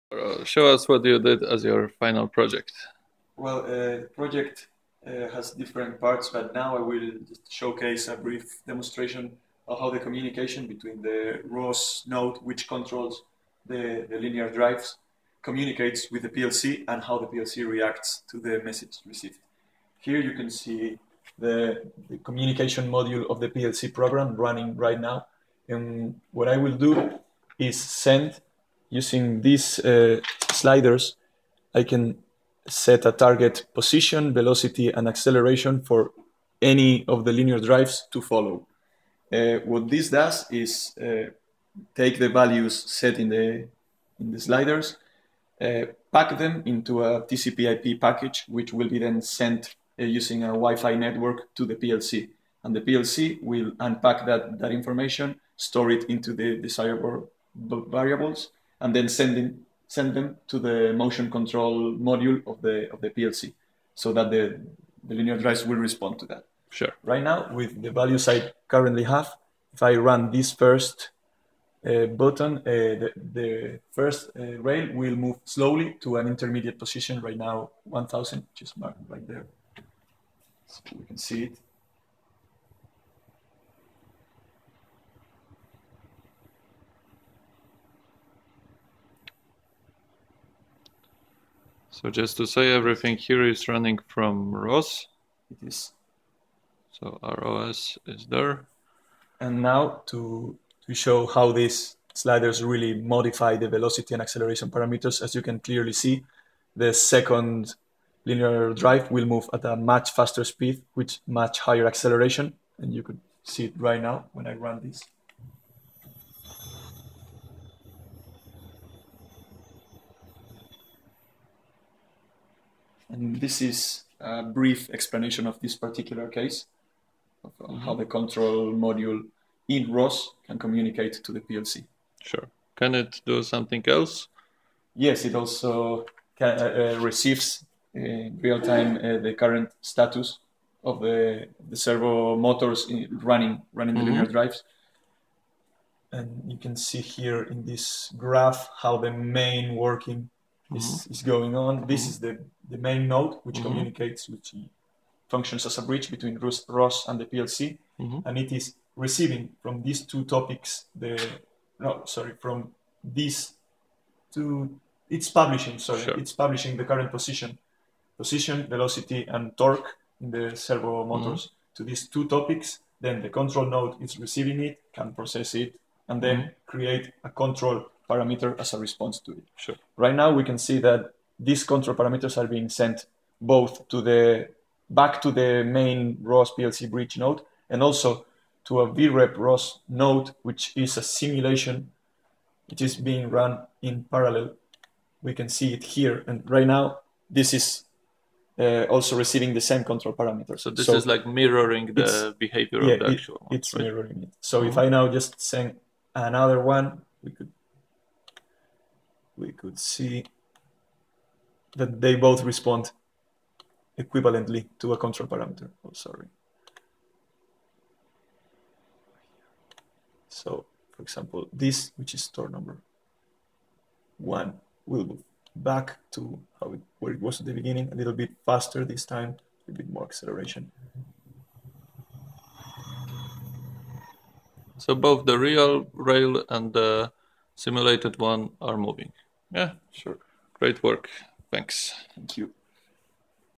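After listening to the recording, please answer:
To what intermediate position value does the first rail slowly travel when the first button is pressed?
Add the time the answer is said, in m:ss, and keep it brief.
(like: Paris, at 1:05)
1000, at 1:17.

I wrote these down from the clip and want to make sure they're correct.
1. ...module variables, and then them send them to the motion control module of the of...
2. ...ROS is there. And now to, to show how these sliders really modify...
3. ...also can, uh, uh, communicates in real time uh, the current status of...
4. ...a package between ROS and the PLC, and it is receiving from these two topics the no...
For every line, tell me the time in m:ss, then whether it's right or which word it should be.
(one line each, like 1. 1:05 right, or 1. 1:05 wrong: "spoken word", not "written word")
1. 0:56 wrong: "desirable", not "module"
2. 1:37 right
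3. 2:15 wrong: "receives", not "communicates"
4. 2:35 wrong: "bridge", not "package".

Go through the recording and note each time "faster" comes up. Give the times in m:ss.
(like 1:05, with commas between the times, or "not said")
1:50, 3:48.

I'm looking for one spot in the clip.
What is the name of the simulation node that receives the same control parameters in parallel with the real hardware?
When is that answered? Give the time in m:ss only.
3:08.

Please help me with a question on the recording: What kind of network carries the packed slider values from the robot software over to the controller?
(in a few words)
Wi-Fi.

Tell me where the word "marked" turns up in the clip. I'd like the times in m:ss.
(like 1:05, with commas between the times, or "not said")
1:18.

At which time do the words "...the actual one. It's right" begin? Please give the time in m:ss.
3:22.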